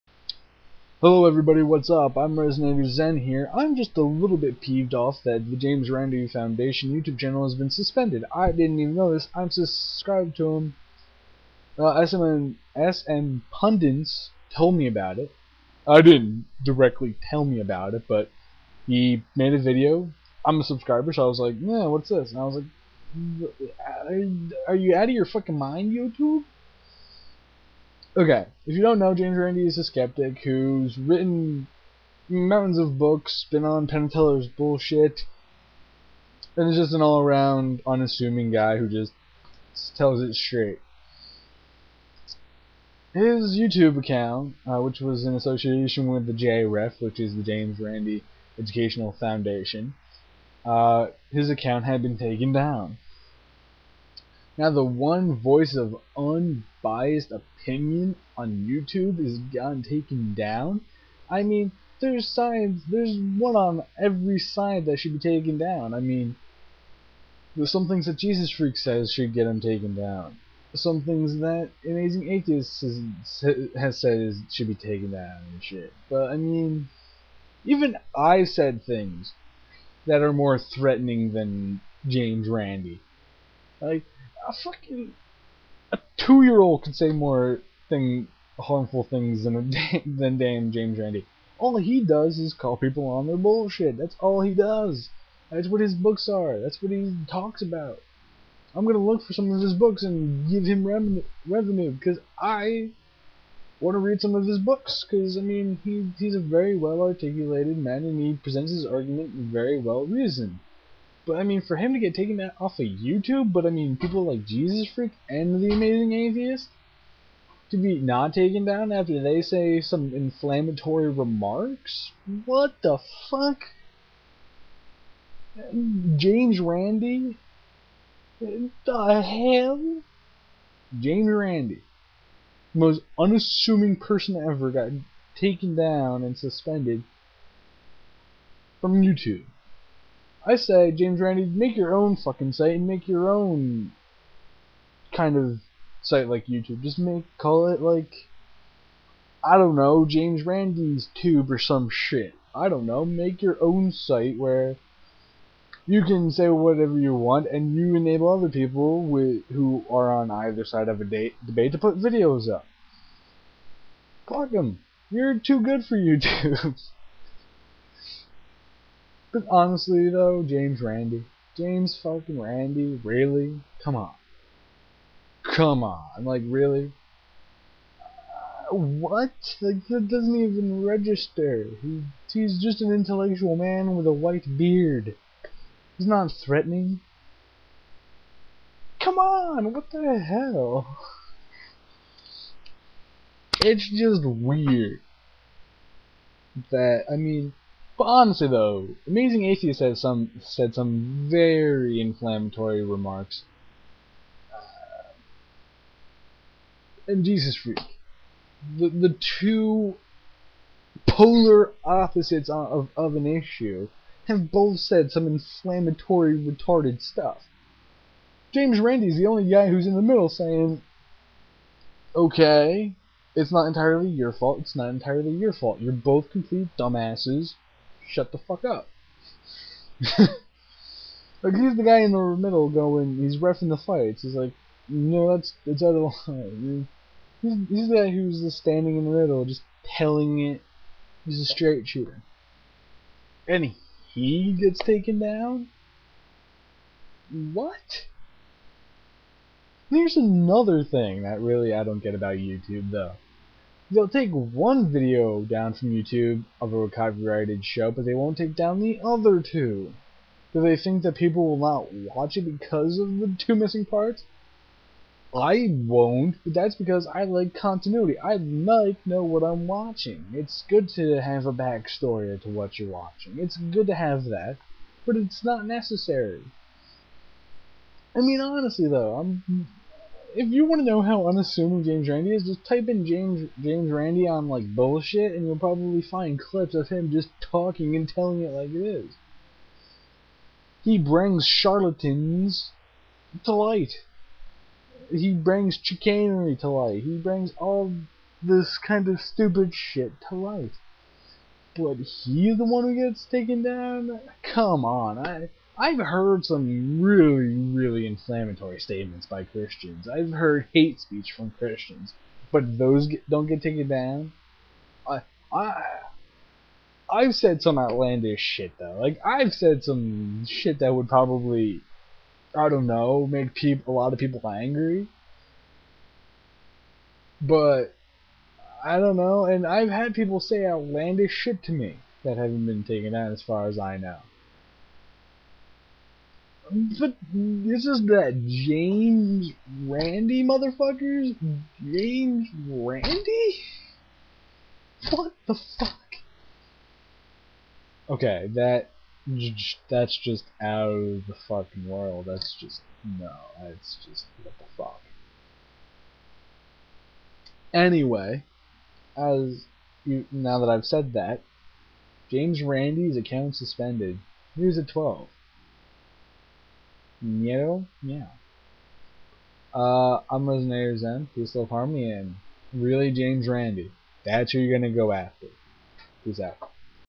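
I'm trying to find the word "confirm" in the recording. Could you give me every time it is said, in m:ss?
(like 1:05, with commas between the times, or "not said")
not said.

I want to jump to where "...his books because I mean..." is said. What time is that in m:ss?
1:44.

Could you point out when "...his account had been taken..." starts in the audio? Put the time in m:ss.
0:51.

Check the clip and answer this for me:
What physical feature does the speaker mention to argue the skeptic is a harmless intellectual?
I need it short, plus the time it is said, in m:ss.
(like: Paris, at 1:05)
a white beard, at 3:04.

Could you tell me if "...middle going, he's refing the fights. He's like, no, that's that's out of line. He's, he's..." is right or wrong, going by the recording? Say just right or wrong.
right.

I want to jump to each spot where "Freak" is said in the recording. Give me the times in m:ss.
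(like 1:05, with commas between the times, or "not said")
1:08, 1:54, 3:27.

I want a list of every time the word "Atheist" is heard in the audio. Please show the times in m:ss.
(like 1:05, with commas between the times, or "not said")
1:12, 1:56, 3:19.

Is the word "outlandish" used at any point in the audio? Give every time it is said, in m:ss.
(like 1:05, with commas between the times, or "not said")
5:17, 5:30.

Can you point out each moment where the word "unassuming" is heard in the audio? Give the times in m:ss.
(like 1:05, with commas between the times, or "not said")
0:37, 2:13, 4:41.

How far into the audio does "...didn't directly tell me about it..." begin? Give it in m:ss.
0:16.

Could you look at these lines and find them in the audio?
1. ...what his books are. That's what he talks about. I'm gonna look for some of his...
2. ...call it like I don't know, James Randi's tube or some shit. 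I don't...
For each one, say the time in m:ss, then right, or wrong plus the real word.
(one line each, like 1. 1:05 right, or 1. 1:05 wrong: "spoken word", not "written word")
1. 1:35 right
2. 2:27 right.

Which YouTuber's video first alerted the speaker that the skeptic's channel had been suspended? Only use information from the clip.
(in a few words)
SM Pundits.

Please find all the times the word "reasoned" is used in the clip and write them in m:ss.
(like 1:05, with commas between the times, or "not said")
1:50.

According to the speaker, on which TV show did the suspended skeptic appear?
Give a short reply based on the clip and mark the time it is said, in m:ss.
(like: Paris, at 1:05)
Penn and Teller's Bullshit, at 0:33.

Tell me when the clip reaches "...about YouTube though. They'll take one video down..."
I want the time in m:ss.
4:12.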